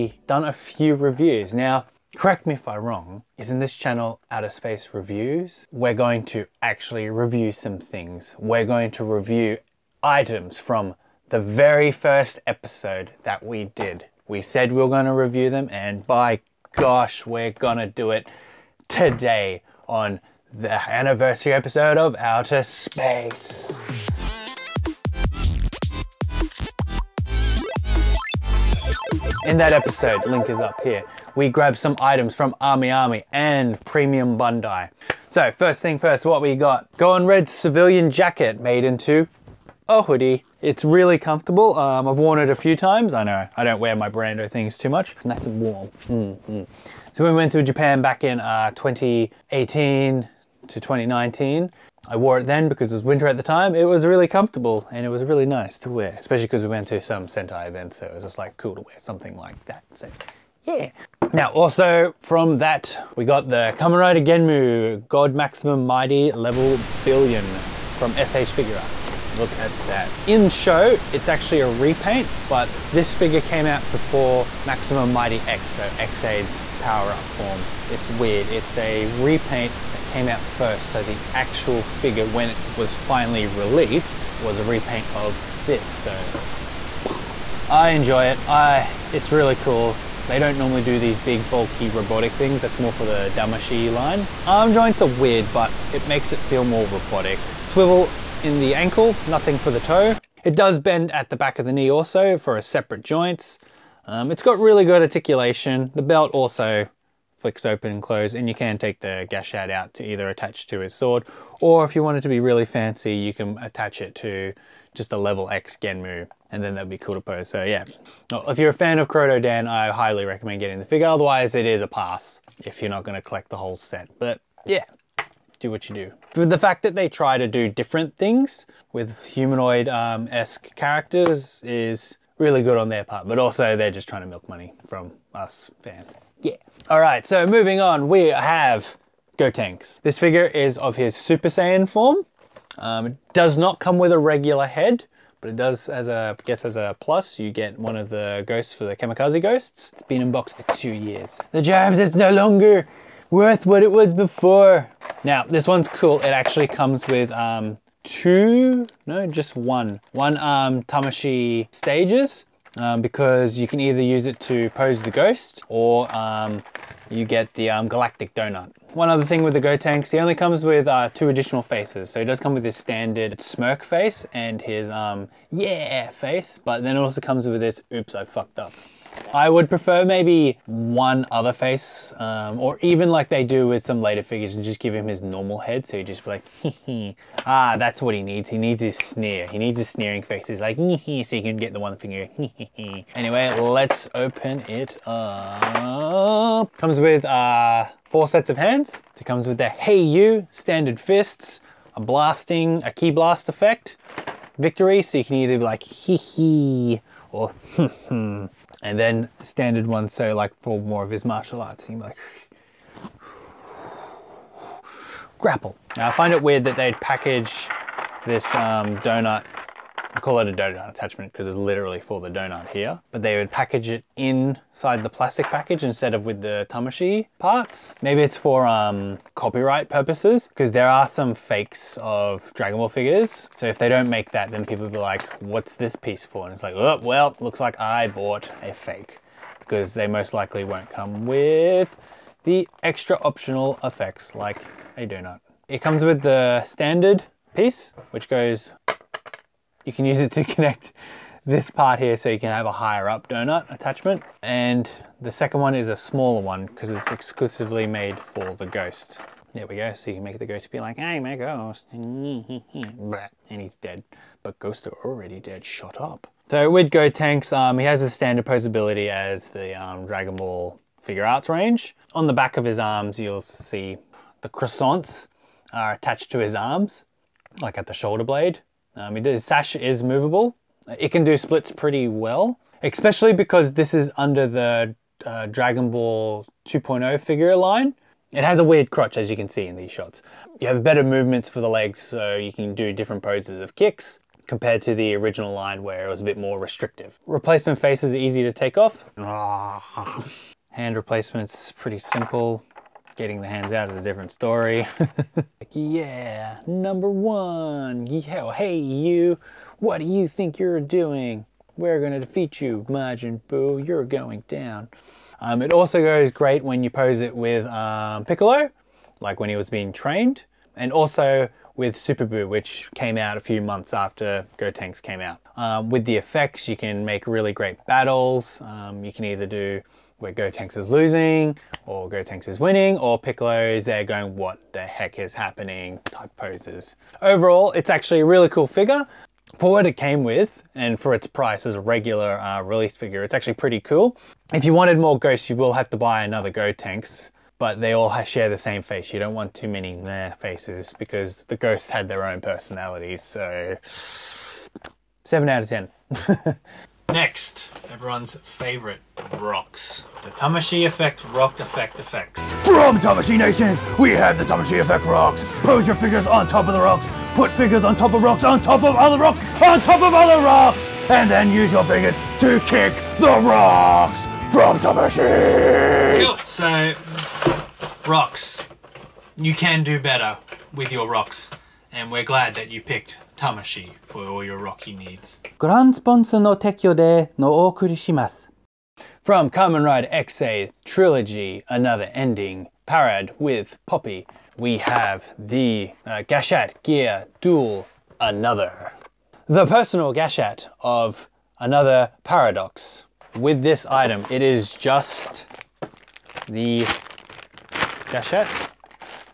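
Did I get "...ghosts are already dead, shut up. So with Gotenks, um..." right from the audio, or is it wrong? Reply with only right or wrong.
right.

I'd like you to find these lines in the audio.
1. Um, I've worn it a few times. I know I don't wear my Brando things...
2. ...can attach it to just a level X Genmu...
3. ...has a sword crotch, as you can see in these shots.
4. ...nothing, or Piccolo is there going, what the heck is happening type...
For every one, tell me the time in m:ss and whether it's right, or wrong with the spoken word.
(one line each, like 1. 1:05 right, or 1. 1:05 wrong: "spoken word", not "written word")
1. 0:41 right
2. 1:53 right
3. 4:48 wrong: "weird", not "sword"
4. 5:32 wrong: "winning", not "nothing".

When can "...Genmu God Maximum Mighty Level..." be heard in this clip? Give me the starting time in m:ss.
1:04.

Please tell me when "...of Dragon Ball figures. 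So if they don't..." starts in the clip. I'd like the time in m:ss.
3:52.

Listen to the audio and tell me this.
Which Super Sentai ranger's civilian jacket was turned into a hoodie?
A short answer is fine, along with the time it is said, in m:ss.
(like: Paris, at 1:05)
Go-on Red, at 0:36.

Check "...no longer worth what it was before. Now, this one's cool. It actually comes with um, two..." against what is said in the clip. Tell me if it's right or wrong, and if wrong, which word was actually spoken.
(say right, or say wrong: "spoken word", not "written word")
right.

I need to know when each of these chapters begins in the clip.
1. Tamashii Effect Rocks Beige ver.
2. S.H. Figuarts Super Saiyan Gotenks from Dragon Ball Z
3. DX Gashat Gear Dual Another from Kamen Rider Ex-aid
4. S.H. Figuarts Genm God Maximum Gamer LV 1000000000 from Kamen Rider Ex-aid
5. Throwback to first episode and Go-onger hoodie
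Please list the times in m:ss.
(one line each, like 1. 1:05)
1. 5:56
2. 2:16
3. 6:28
4. 1:01
5. 0:28.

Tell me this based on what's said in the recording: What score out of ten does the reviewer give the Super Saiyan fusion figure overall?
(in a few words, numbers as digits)
7.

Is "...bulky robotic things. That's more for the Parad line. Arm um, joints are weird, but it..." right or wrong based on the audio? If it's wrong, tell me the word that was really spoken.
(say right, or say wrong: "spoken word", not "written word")
wrong: "Tamashii", not "Parad".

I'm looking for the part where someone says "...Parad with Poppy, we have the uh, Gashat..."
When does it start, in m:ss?
6:32.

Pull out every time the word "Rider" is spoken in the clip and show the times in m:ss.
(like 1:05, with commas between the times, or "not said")
1:03, 6:29.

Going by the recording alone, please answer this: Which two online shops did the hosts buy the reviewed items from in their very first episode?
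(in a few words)
AmiAmi and Premium Bandai.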